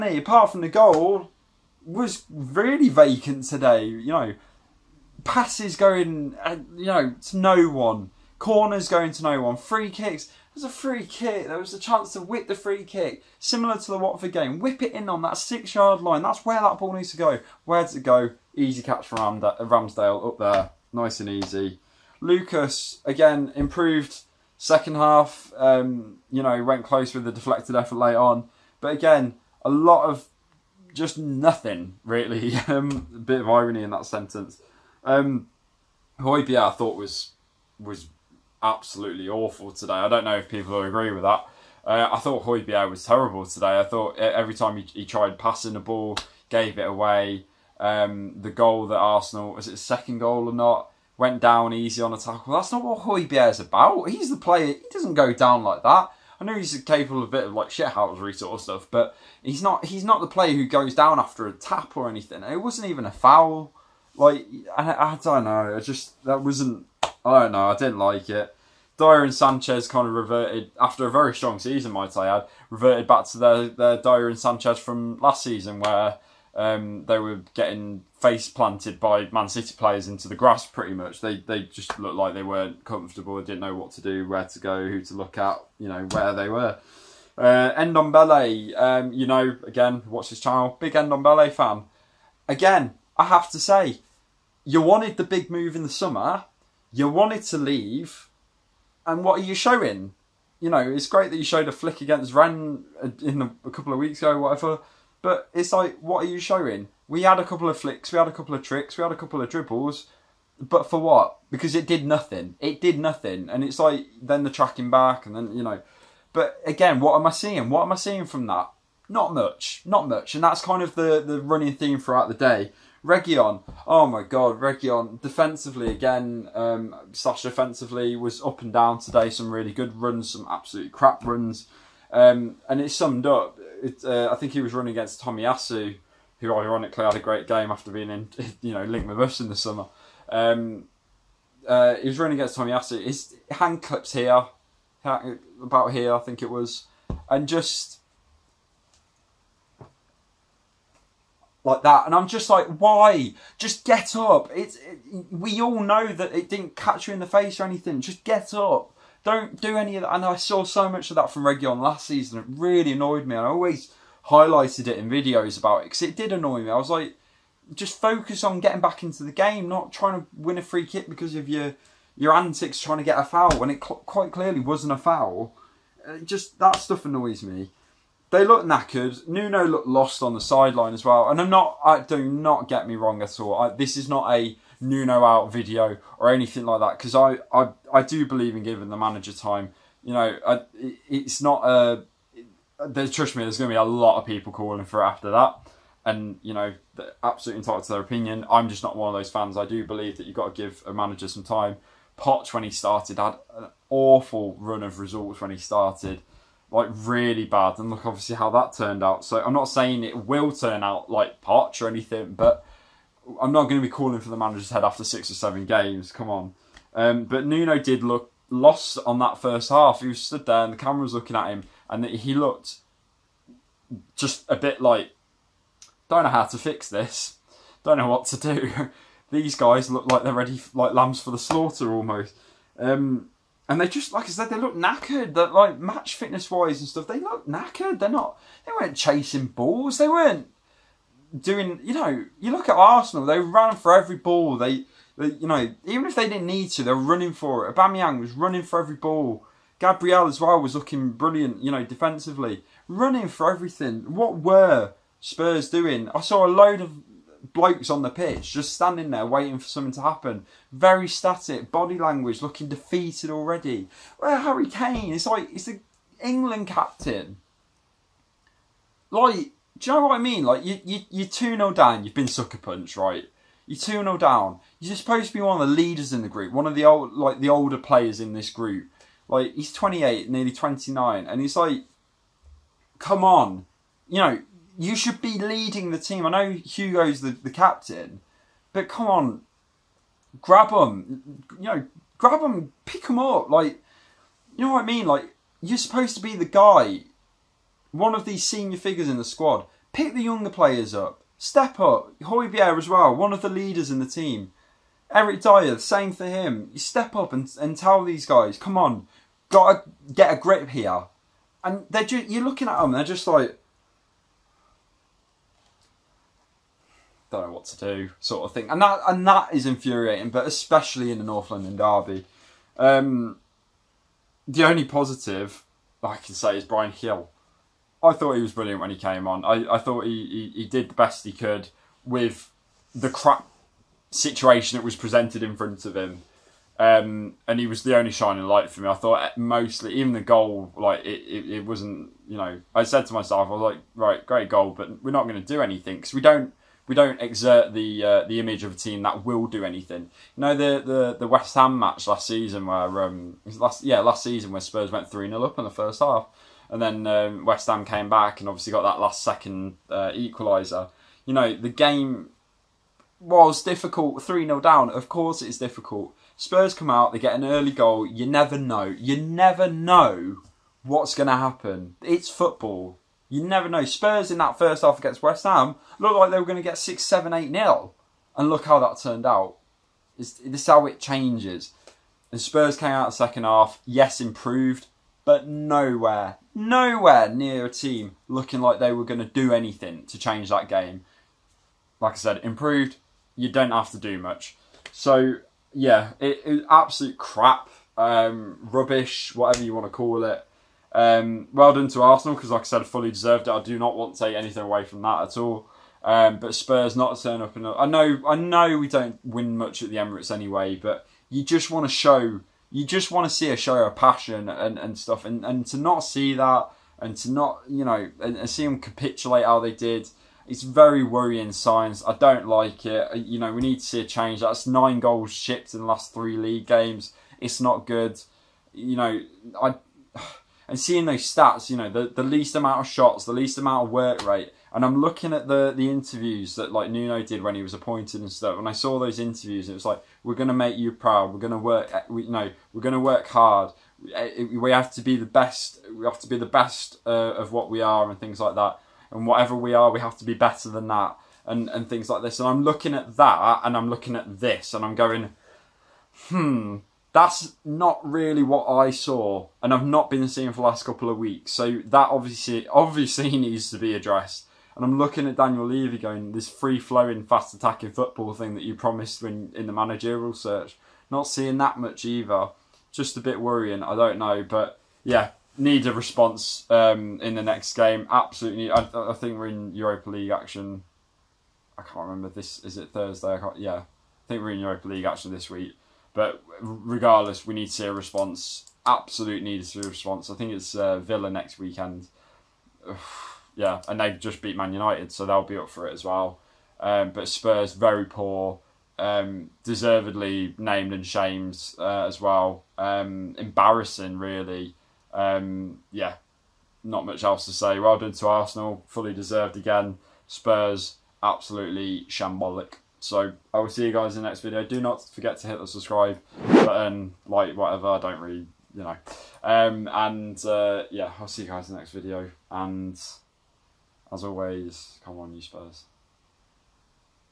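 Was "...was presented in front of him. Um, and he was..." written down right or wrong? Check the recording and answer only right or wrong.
right.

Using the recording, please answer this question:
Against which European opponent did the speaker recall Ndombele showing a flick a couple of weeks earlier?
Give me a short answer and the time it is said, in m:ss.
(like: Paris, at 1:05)
Rennes, at 1:42.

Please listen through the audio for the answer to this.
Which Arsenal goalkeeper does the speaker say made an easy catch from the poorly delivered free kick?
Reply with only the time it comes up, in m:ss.
0:19.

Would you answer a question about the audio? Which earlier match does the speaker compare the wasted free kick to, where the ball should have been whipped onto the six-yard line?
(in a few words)
Watford game.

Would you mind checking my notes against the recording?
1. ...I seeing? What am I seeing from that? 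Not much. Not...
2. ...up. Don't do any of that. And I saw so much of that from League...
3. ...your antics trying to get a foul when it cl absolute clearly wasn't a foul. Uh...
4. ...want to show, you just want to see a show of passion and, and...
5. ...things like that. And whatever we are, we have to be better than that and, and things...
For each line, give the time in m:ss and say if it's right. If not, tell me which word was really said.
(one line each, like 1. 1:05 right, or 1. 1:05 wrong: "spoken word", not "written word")
1. 1:57 right
2. 2:38 wrong: "Reguilón", not "League"
3. 2:52 wrong: "quite", not "absolute"
4. 6:51 right
5. 7:28 right.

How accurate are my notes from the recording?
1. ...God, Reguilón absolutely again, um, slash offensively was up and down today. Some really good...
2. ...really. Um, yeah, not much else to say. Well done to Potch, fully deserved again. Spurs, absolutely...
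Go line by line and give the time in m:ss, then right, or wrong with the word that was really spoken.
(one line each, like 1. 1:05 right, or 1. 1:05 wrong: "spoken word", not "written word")
1. 2:04 wrong: "defensively", not "absolutely"
2. 8:24 wrong: "Arsenal", not "Potch".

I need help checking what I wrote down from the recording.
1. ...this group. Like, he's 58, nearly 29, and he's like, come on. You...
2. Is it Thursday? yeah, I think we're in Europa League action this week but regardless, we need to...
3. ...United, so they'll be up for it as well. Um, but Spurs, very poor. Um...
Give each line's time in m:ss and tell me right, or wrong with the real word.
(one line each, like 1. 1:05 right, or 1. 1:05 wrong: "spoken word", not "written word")
1. 4:38 wrong: "28", not "58"
2. 8:02 right
3. 8:14 right.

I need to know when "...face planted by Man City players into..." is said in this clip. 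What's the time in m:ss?
1:18.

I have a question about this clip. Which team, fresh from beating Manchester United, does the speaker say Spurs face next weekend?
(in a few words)
Villa.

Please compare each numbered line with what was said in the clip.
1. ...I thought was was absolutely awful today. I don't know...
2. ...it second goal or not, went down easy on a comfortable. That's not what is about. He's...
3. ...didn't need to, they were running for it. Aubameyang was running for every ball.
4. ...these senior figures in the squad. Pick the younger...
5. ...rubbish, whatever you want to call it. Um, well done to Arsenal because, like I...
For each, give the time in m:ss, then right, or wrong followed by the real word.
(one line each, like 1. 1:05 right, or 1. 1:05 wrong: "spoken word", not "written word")
1. 0:36 right
2. 0:49 wrong: "tackle", not "comfortable"
3. 4:06 right
4. 4:58 right
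5. 6:38 right.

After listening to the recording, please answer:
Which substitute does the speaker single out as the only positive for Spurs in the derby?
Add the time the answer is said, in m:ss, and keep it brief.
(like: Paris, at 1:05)
Bryan Gil, at 5:26.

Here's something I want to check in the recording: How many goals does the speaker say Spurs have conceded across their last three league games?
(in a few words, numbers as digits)
9.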